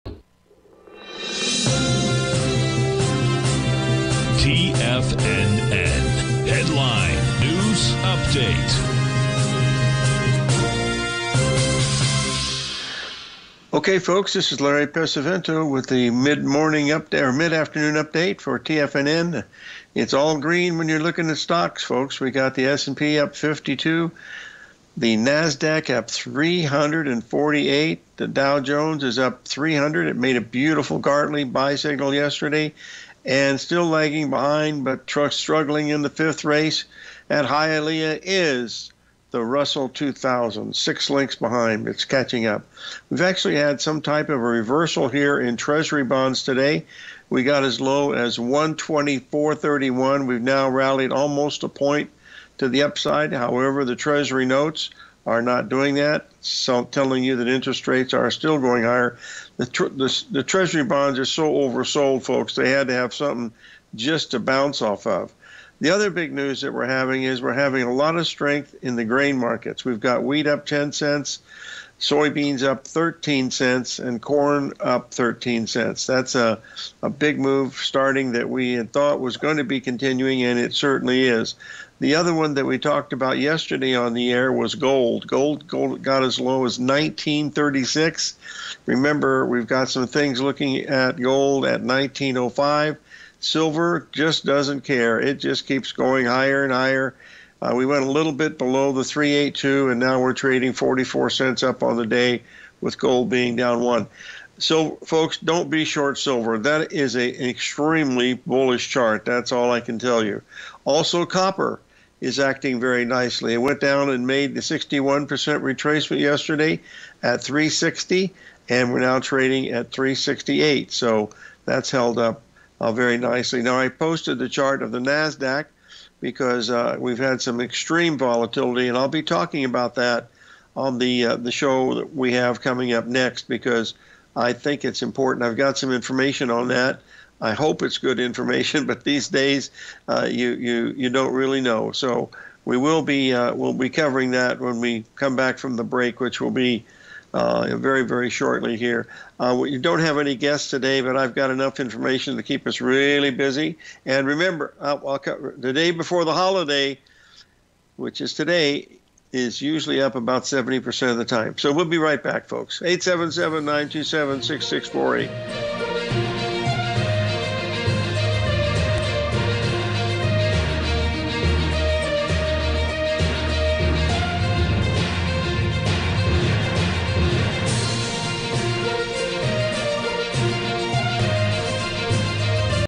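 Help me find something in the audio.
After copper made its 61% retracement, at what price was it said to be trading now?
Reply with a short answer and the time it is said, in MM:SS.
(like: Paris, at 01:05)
368, at 01:59.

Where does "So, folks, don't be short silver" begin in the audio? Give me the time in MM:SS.
01:44.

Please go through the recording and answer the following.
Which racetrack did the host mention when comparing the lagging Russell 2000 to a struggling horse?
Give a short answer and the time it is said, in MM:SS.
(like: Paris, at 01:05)
Hialeah, at 00:37.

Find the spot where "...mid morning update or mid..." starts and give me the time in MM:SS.
00:16.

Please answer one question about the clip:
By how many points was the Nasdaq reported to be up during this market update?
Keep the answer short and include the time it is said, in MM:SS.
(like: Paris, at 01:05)
348, at 00:26.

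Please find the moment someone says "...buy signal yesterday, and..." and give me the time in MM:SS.
00:31.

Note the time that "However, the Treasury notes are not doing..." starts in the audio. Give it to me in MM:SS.
00:53.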